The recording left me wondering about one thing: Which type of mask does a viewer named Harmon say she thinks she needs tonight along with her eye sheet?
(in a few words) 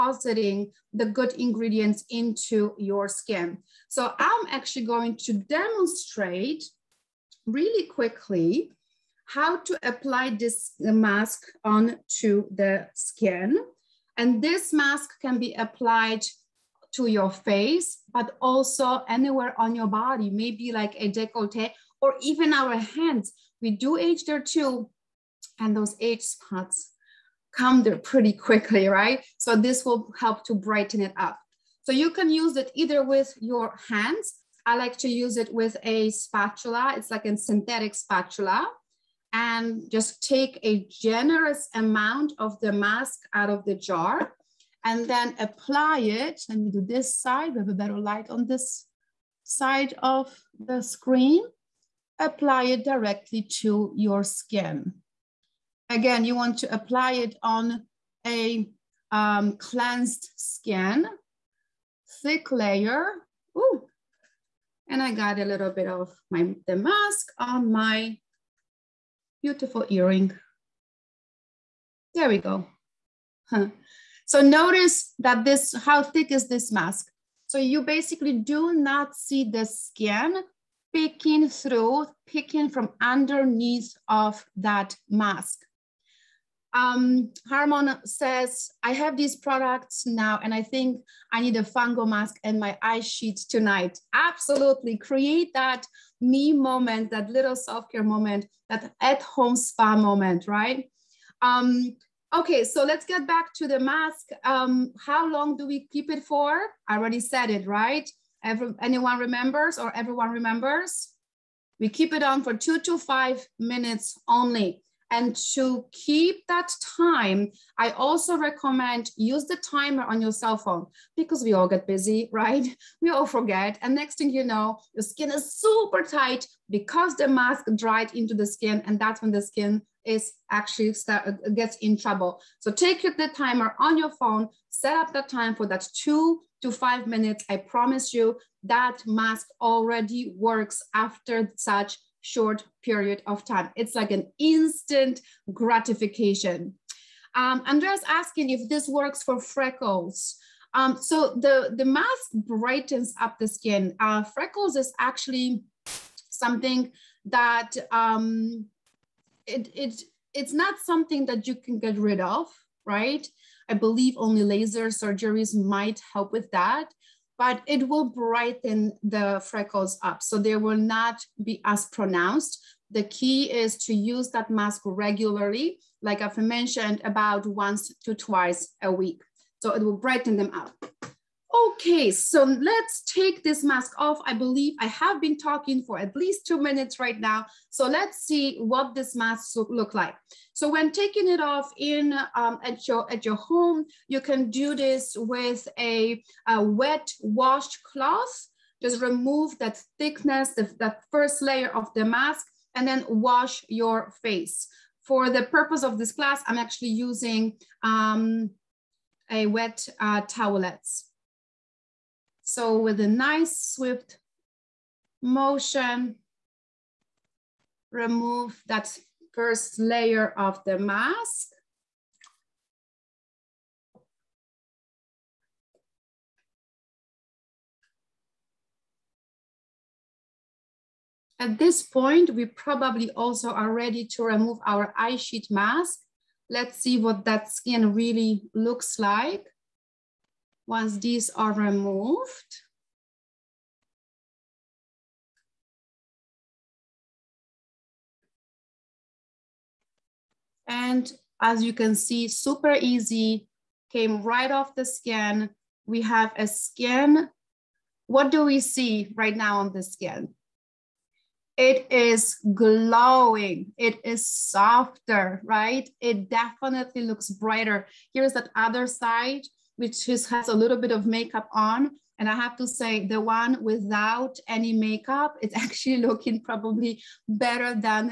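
Fango mask.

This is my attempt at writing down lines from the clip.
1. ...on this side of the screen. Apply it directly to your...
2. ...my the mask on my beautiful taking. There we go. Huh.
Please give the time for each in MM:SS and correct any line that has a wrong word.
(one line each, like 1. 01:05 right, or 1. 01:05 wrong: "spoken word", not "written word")
1. 00:48 right
2. 01:06 wrong: "earring", not "taking".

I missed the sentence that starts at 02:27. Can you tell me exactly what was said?
Um, Andrea's asking if this works for freckles.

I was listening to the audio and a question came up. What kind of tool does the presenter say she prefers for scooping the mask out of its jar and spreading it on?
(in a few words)
synthetic spatula.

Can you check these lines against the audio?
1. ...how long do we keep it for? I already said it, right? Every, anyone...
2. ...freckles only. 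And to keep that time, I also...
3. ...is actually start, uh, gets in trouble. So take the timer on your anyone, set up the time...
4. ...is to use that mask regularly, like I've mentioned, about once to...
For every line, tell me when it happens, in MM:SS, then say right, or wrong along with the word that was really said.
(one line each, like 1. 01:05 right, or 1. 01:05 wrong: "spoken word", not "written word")
1. 01:44 right
2. 01:53 wrong: "minutes", not "freckles"
3. 02:10 wrong: "phone", not "anyone"
4. 02:53 right.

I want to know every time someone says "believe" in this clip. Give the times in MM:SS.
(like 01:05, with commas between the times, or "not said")
02:43, 03:04.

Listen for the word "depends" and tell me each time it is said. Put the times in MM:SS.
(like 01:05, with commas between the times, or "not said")
not said.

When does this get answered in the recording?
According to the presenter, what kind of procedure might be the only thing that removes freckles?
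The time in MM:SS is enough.
02:44.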